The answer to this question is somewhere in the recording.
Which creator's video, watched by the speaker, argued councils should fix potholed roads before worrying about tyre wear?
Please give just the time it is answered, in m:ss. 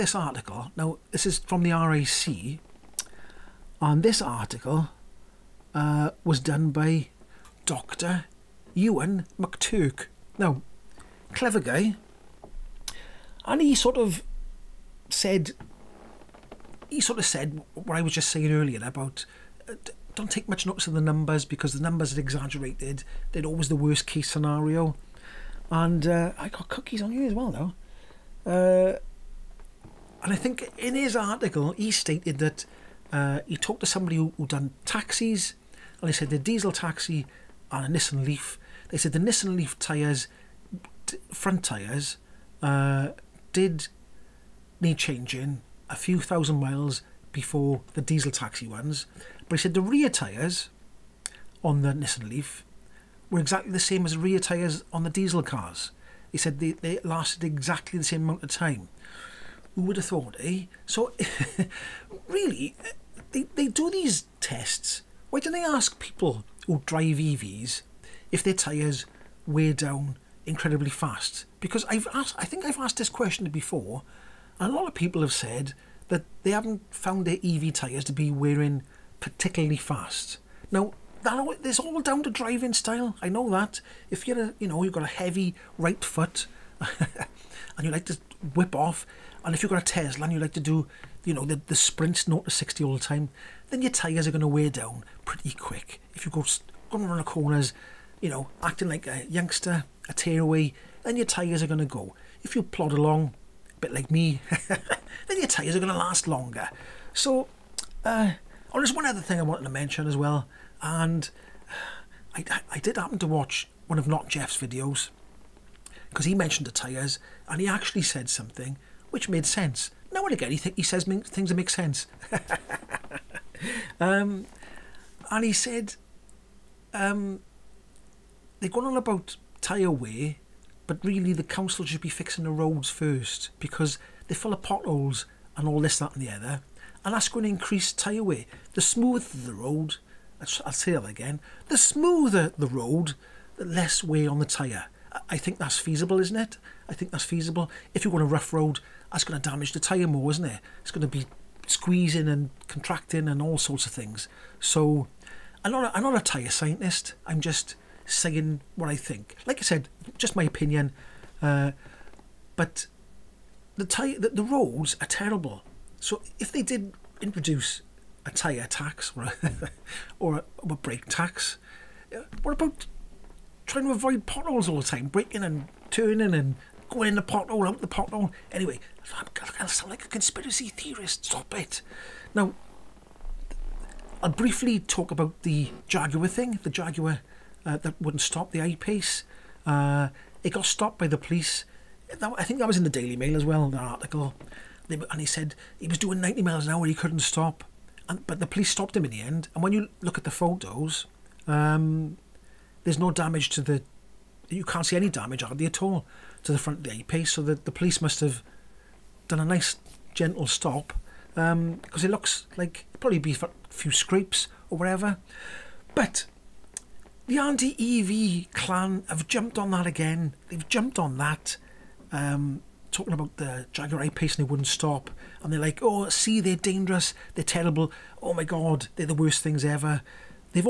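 1:54.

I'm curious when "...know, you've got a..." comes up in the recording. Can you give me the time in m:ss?
1:24.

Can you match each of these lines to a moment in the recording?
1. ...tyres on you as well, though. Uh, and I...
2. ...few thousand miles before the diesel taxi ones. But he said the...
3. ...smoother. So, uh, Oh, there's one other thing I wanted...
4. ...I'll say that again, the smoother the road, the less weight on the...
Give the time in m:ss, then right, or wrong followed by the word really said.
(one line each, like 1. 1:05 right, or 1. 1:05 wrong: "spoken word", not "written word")
1. 0:26 wrong: "cookies", not "tyres"
2. 0:45 right
3. 1:46 wrong: "longer", not "smoother"
4. 2:20 right.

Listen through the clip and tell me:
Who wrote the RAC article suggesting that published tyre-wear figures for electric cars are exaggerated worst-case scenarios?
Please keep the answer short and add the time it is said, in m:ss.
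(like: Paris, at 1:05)
Dr. Euan McTurk, at 0:07.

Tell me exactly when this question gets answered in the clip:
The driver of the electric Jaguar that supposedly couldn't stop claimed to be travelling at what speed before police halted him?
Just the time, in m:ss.
3:16.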